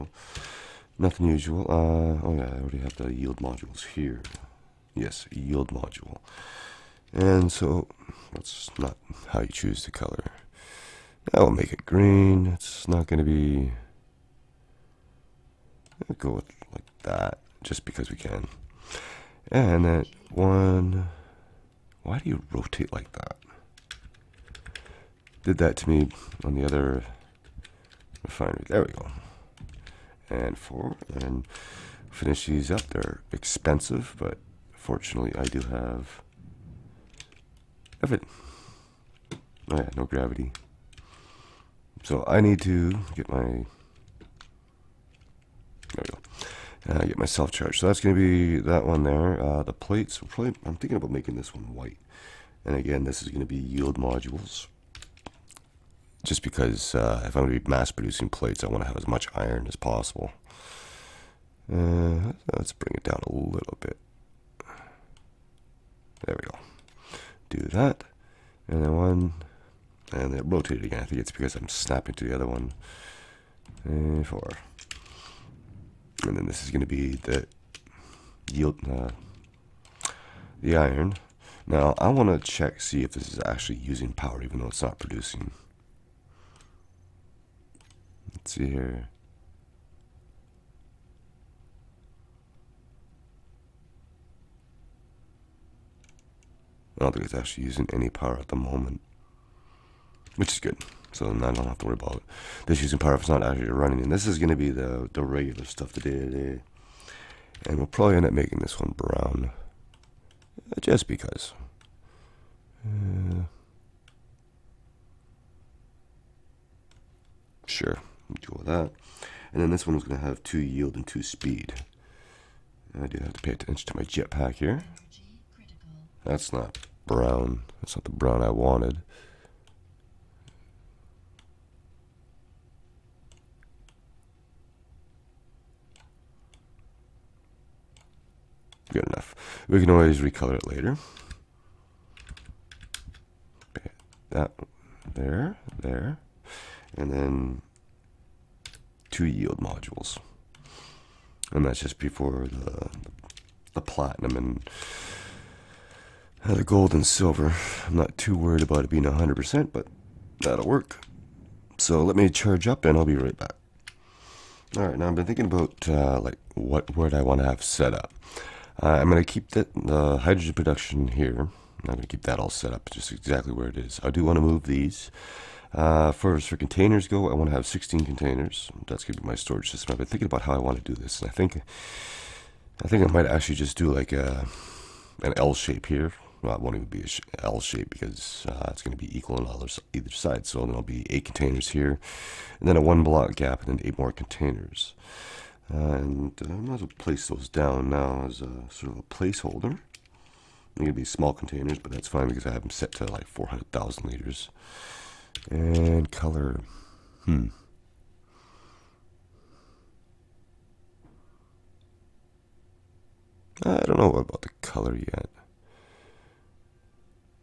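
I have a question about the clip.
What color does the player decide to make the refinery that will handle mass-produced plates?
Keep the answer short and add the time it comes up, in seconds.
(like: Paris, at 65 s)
White, at 51 s.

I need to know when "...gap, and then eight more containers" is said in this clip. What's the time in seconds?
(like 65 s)
193 s.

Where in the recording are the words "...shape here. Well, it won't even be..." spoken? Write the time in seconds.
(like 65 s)
185 s.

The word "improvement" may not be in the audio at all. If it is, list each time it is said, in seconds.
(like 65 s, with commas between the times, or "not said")
not said.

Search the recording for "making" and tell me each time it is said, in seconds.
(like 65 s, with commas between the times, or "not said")
51 s, 108 s.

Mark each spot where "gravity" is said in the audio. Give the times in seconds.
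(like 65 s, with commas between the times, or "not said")
40 s.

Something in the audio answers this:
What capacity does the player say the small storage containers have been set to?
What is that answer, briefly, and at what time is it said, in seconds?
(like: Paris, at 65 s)
400,000 liters, at 203 s.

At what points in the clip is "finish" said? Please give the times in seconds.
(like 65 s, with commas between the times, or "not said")
32 s.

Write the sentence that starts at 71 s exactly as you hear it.
I think it's because I'm snapping to the other one.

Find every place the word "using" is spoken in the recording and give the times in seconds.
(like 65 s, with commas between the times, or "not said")
83 s, 97 s, 102 s.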